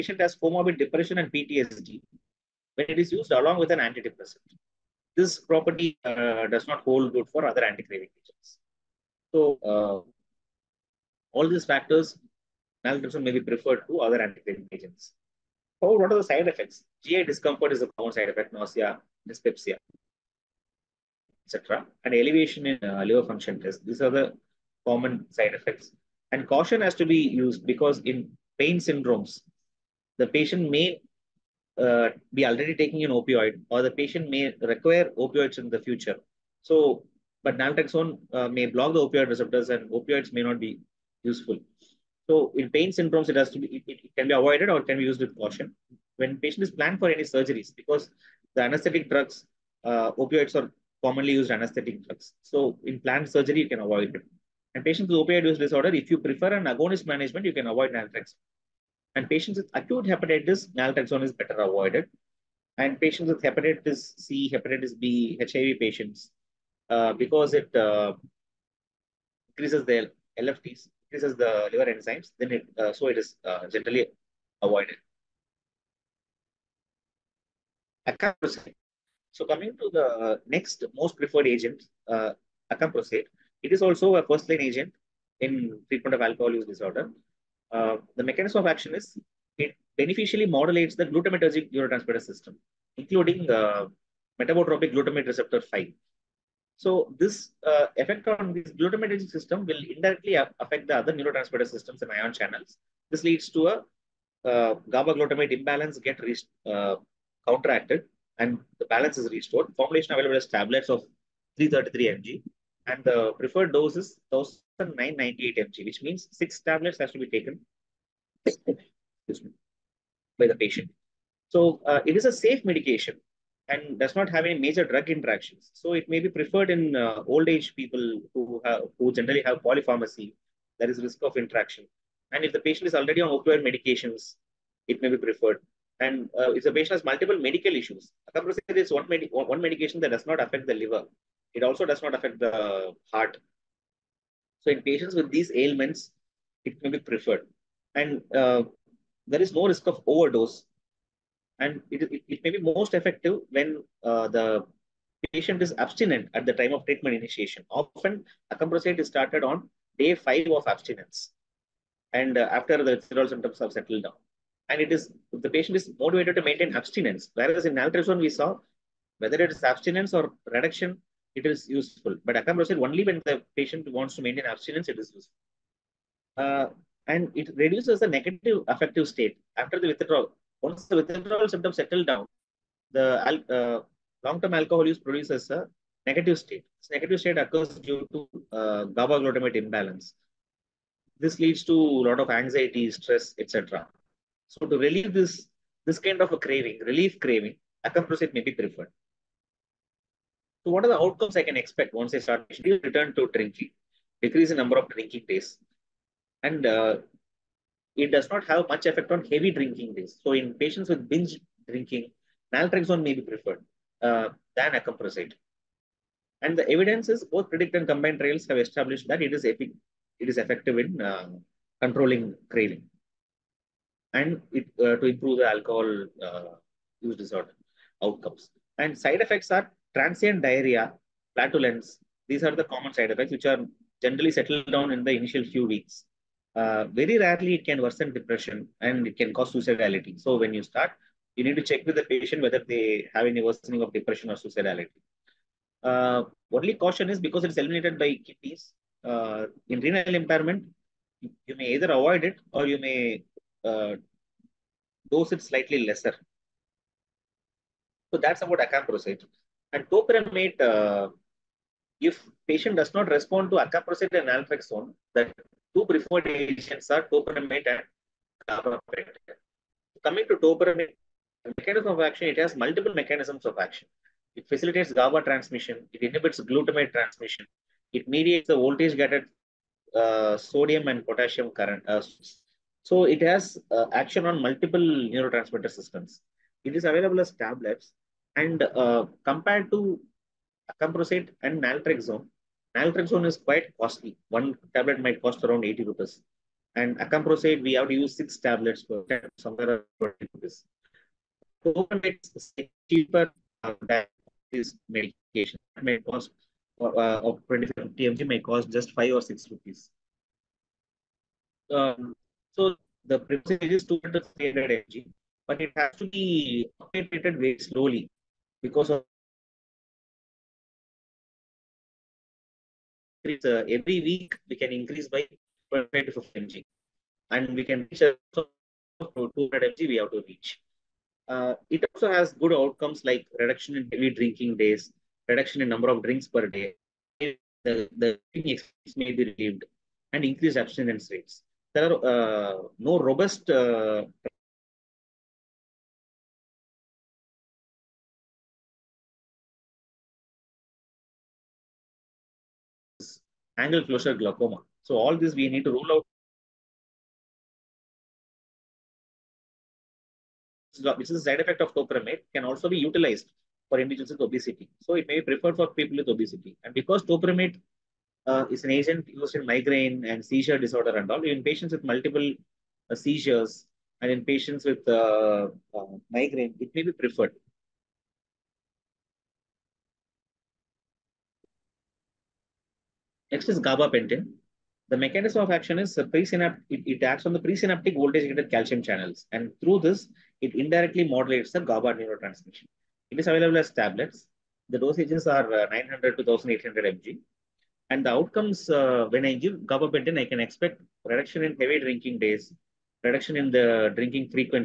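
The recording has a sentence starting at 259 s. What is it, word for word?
And topiramate, uh, if patient does not respond to acamprosate and naltrexone, that two preferred agents are topiramate and gabapentin.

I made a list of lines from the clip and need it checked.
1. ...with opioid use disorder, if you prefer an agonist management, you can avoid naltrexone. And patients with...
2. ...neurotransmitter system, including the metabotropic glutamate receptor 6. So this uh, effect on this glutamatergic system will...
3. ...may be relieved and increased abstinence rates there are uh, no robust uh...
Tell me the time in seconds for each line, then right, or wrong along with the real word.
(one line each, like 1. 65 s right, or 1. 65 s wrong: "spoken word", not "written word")
1. 55 s right
2. 91 s wrong: "5", not "6"
3. 339 s right.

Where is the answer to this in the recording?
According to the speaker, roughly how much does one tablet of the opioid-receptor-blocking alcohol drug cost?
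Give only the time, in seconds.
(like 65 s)
295 s.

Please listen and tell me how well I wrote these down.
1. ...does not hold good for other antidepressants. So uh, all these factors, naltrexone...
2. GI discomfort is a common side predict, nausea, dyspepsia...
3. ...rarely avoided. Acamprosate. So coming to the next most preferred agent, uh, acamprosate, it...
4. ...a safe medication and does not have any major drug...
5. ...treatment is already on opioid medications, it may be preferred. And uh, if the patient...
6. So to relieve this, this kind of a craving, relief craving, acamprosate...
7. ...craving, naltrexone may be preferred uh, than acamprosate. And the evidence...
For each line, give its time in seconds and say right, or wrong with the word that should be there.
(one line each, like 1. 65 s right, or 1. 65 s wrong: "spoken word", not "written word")
1. 6 s right
2. 17 s wrong: "effect", not "predict"
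3. 73 s wrong: "generally", not "rarely"
4. 122 s right
5. 132 s wrong: "patient", not "treatment"
6. 194 s right
7. 211 s wrong: "drinking", not "craving".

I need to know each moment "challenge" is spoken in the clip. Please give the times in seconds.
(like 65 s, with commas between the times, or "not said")
not said.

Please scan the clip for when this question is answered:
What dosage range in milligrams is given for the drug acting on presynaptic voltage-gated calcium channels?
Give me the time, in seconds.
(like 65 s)
395 s.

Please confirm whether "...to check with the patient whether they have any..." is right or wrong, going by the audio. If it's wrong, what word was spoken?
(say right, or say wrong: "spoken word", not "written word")
right.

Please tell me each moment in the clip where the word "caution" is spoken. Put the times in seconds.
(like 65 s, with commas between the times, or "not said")
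26 s, 45 s, 246 s.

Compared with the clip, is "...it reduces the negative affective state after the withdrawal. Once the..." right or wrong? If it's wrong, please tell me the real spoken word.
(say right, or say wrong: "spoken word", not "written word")
right.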